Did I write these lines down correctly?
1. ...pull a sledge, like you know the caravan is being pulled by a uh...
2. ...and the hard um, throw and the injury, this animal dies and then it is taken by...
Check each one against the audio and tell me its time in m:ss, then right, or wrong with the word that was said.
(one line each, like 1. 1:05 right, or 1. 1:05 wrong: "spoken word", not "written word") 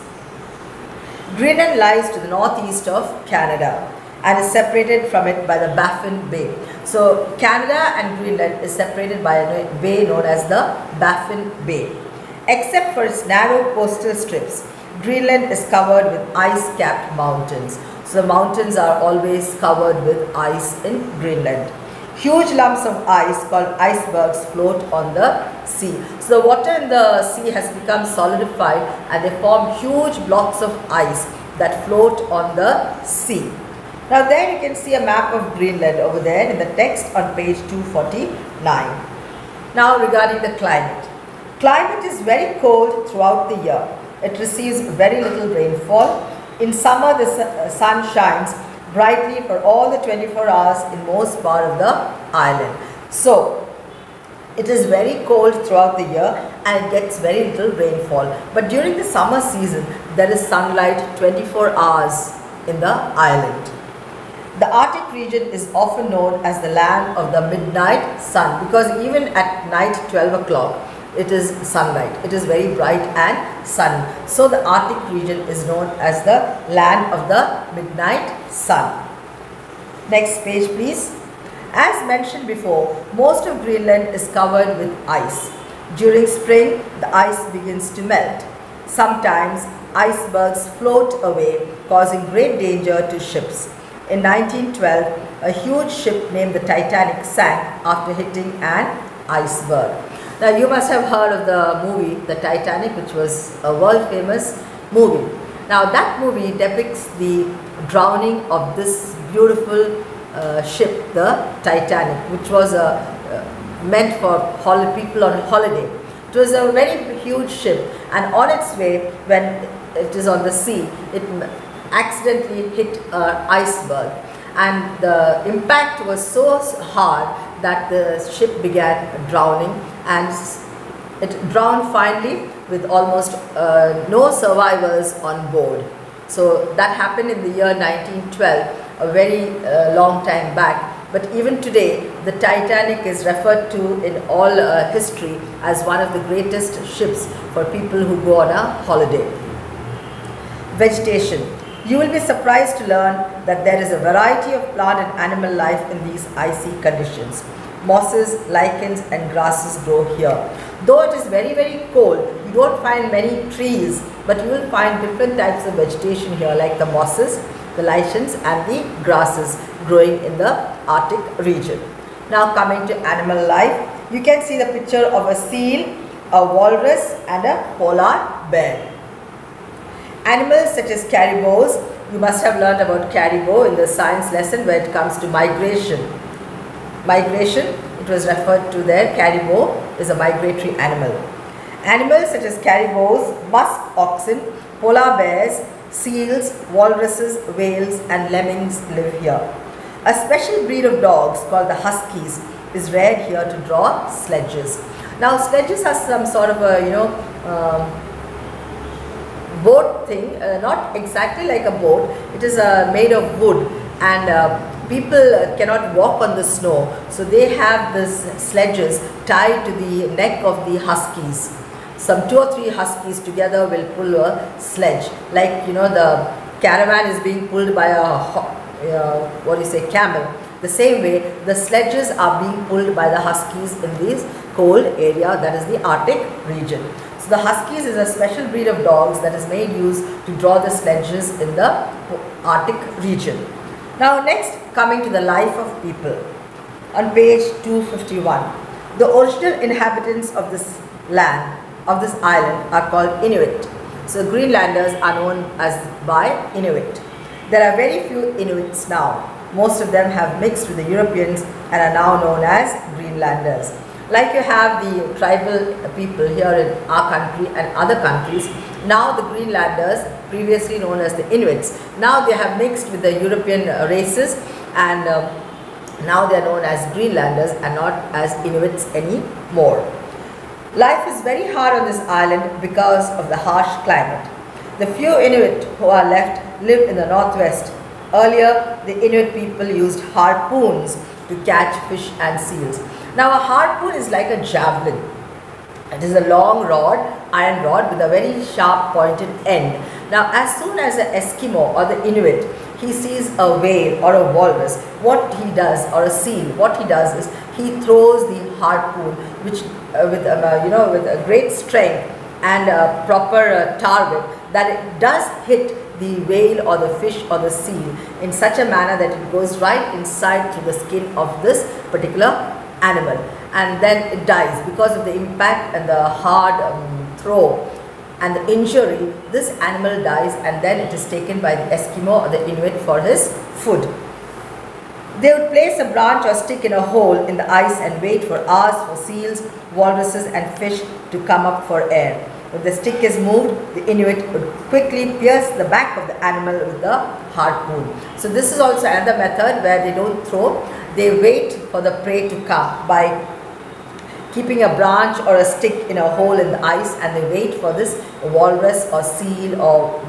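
1. 3:43 right
2. 5:25 right.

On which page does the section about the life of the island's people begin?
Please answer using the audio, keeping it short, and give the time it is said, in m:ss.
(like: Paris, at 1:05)
251, at 4:07.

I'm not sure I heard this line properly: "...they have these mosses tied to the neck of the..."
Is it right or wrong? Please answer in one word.
wrong.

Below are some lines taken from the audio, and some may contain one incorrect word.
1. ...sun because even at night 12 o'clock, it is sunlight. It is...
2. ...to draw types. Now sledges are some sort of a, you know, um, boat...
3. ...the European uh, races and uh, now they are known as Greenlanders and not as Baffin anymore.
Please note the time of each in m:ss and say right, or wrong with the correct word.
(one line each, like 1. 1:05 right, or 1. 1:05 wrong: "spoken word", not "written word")
1. 1:08 right
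2. 3:23 wrong: "sledges", not "types"
3. 4:33 wrong: "Inuits", not "Baffin".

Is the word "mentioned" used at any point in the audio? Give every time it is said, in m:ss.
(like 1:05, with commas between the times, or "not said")
1:22.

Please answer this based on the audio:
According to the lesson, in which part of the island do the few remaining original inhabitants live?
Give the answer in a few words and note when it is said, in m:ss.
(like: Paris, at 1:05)
Northwest, at 4:47.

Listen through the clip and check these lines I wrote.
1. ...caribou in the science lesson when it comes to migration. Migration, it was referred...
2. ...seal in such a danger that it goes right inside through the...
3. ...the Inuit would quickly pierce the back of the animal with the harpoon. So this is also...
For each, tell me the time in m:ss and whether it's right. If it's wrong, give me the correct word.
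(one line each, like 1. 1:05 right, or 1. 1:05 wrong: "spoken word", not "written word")
1. 3:03 right
2. 5:17 wrong: "manner", not "danger"
3. 5:43 right.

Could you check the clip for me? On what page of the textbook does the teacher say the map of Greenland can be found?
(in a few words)
249.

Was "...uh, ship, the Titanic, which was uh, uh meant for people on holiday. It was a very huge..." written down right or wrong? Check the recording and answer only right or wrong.
right.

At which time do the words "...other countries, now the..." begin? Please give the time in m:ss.
4:27.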